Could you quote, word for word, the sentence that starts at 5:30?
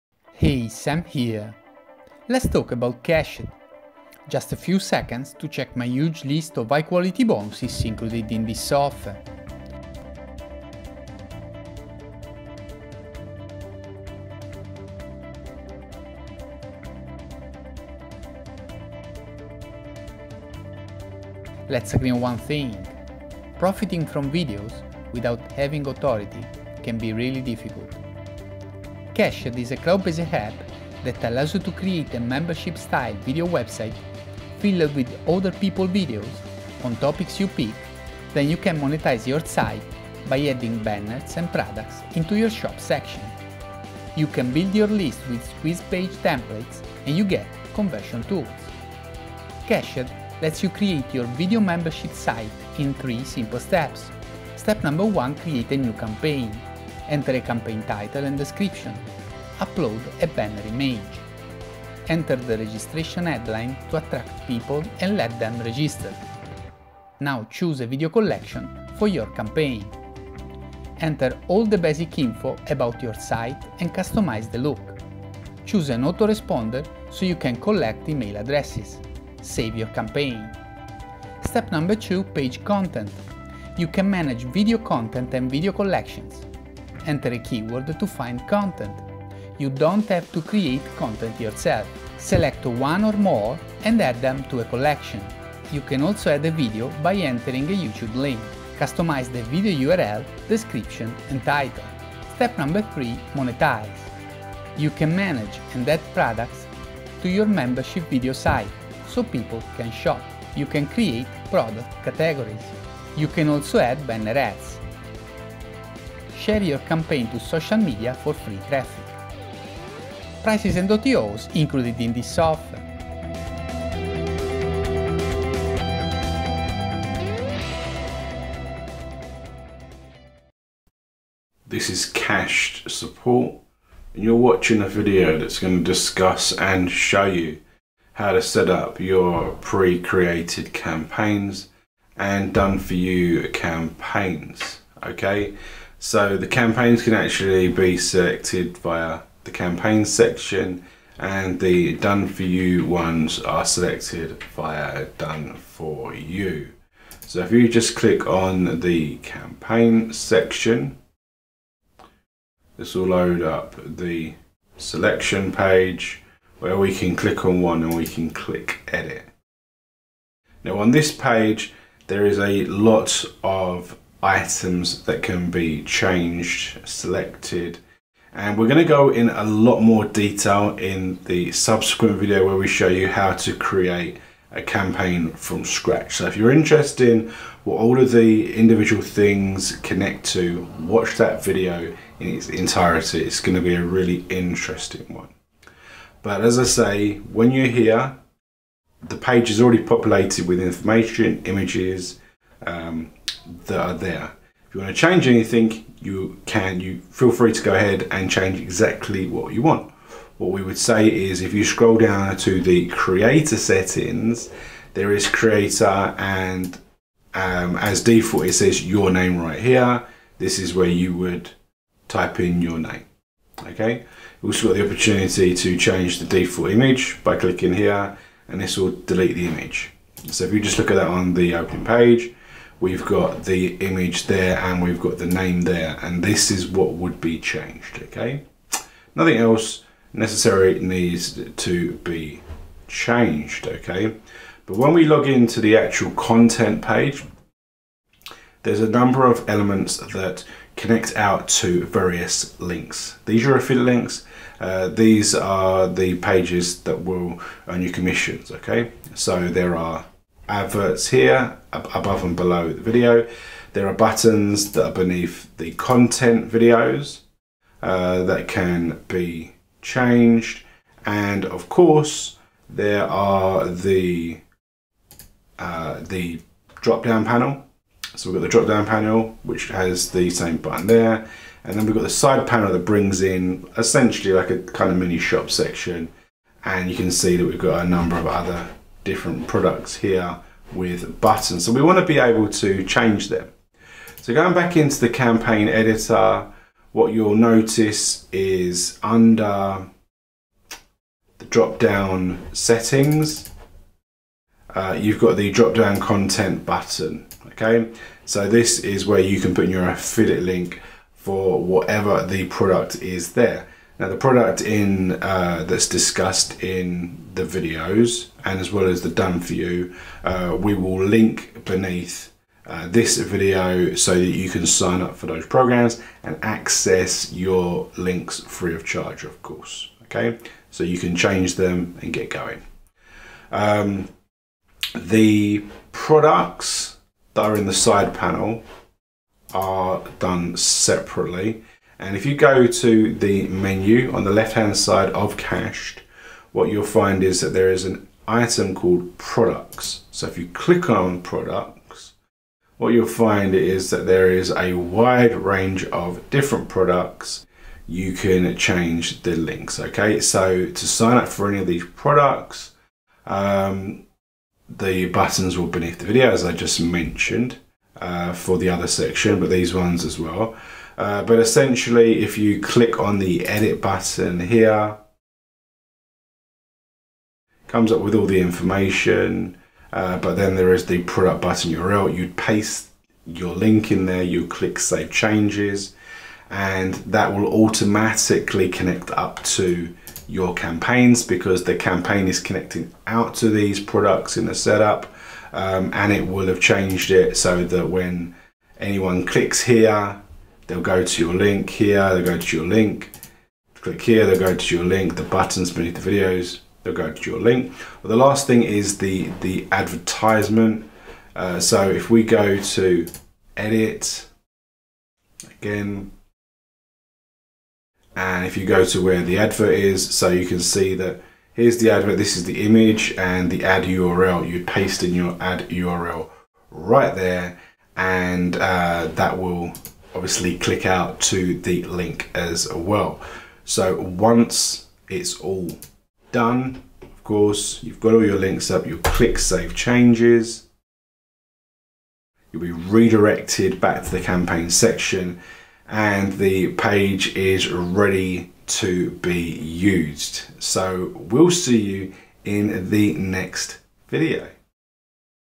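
Okay, so you can change them and get going.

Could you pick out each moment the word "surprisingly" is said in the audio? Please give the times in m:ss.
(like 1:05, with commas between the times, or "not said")
not said.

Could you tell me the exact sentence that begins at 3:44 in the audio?
You've also got the opportunity to change the default image by clicking here and this will delete the image.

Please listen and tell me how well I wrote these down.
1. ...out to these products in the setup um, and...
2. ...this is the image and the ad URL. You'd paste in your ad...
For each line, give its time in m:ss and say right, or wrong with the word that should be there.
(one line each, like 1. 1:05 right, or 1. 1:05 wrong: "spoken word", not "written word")
1. 6:33 right
2. 7:02 right.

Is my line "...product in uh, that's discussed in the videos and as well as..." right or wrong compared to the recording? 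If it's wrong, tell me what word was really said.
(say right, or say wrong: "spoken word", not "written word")
right.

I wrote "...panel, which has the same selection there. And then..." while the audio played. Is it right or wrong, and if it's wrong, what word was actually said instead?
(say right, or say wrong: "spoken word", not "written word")
wrong: "button", not "selection".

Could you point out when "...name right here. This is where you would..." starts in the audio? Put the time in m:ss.
3:39.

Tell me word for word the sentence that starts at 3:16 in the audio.
But as I say, when you're here, the page is already populated with information, images, um, that are there.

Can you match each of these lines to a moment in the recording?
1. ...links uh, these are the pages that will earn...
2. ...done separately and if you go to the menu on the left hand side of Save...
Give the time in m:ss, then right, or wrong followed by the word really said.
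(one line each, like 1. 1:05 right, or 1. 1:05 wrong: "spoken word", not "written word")
1. 4:13 right
2. 5:40 wrong: "Cashed", not "Save".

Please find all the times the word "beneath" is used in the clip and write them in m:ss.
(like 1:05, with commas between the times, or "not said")
4:24, 5:21, 6:05, 6:45.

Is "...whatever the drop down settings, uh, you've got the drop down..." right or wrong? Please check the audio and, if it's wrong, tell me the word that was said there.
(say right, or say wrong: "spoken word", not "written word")
wrong: "under", not "whatever".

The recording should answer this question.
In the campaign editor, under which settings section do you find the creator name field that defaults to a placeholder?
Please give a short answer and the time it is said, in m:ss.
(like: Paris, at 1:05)
Creator settings, at 3:32.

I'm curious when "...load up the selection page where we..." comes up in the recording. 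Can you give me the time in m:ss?
2:43.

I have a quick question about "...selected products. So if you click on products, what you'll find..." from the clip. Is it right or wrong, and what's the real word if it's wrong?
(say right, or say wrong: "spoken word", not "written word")
wrong: "called", not "selected".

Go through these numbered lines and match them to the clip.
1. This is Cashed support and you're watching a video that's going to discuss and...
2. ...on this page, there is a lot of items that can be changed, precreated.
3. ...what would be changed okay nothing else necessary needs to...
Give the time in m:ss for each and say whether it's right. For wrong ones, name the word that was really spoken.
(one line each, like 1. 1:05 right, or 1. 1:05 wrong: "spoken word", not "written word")
1. 2:11 right
2. 2:50 wrong: "selected", not "precreated"
3. 3:56 right.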